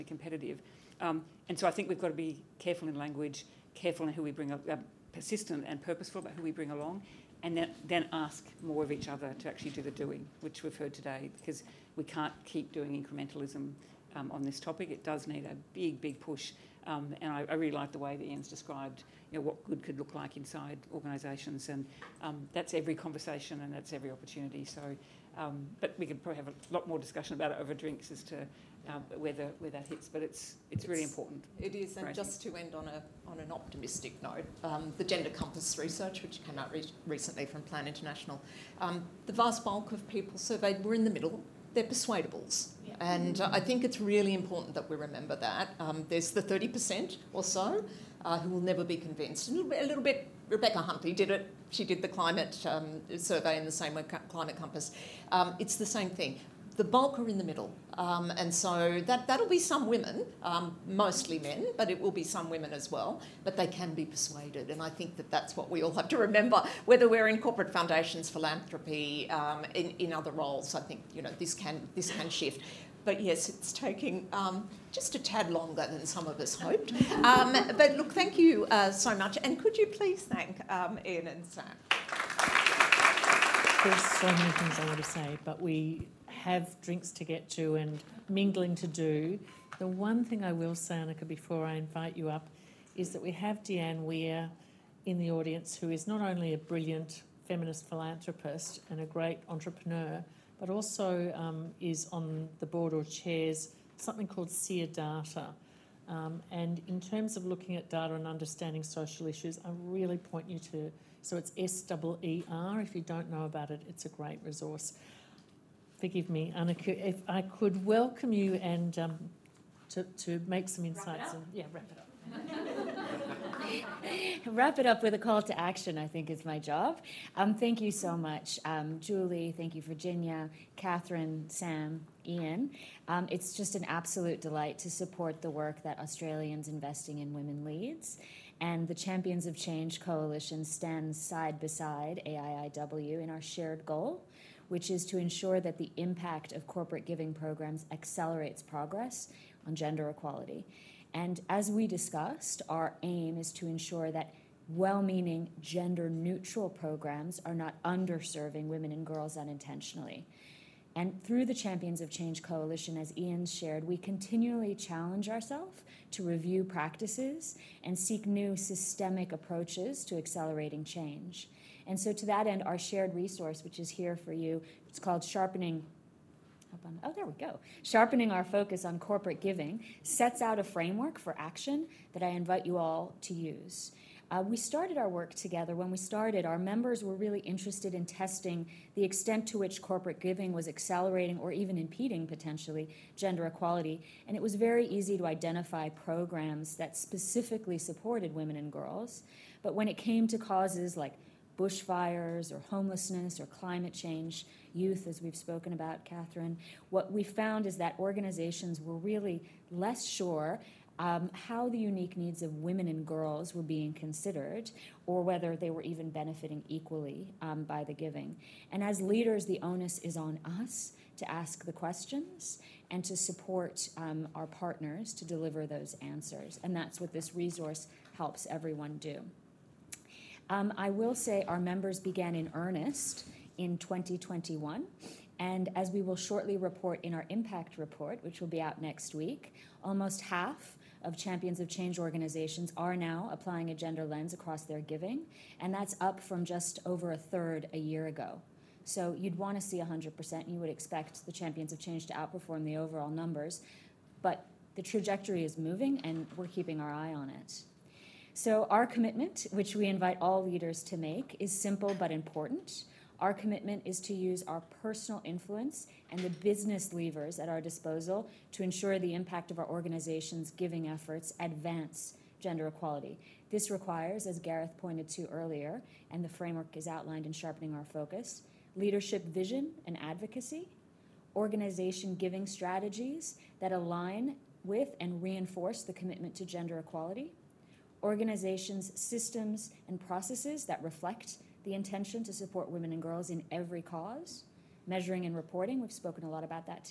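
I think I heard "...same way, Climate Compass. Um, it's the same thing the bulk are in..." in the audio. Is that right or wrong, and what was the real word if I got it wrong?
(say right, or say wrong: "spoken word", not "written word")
right.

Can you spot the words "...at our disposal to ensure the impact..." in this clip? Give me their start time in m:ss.
4:27.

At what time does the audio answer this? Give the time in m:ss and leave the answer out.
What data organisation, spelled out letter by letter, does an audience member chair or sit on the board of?
1:44.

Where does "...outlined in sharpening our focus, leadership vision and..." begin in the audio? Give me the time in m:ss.
4:36.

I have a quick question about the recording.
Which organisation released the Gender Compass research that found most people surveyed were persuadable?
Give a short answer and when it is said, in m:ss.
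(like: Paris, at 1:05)
Plan International, at 0:37.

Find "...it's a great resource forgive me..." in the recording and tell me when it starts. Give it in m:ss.
1:53.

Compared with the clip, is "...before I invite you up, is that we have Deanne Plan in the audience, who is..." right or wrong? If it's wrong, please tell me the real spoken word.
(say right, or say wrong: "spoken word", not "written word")
wrong: "Weir", not "Plan".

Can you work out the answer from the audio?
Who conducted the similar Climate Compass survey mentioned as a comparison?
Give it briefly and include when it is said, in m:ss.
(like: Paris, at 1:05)
Rebecca Huntley, at 0:50.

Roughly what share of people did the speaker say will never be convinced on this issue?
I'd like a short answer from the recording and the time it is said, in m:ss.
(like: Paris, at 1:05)
30%, at 0:46.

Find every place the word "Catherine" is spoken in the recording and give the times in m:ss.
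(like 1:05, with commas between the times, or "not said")
2:10, 3:26.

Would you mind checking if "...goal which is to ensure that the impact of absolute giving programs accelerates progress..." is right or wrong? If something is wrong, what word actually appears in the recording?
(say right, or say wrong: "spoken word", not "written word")
wrong: "corporate", not "absolute".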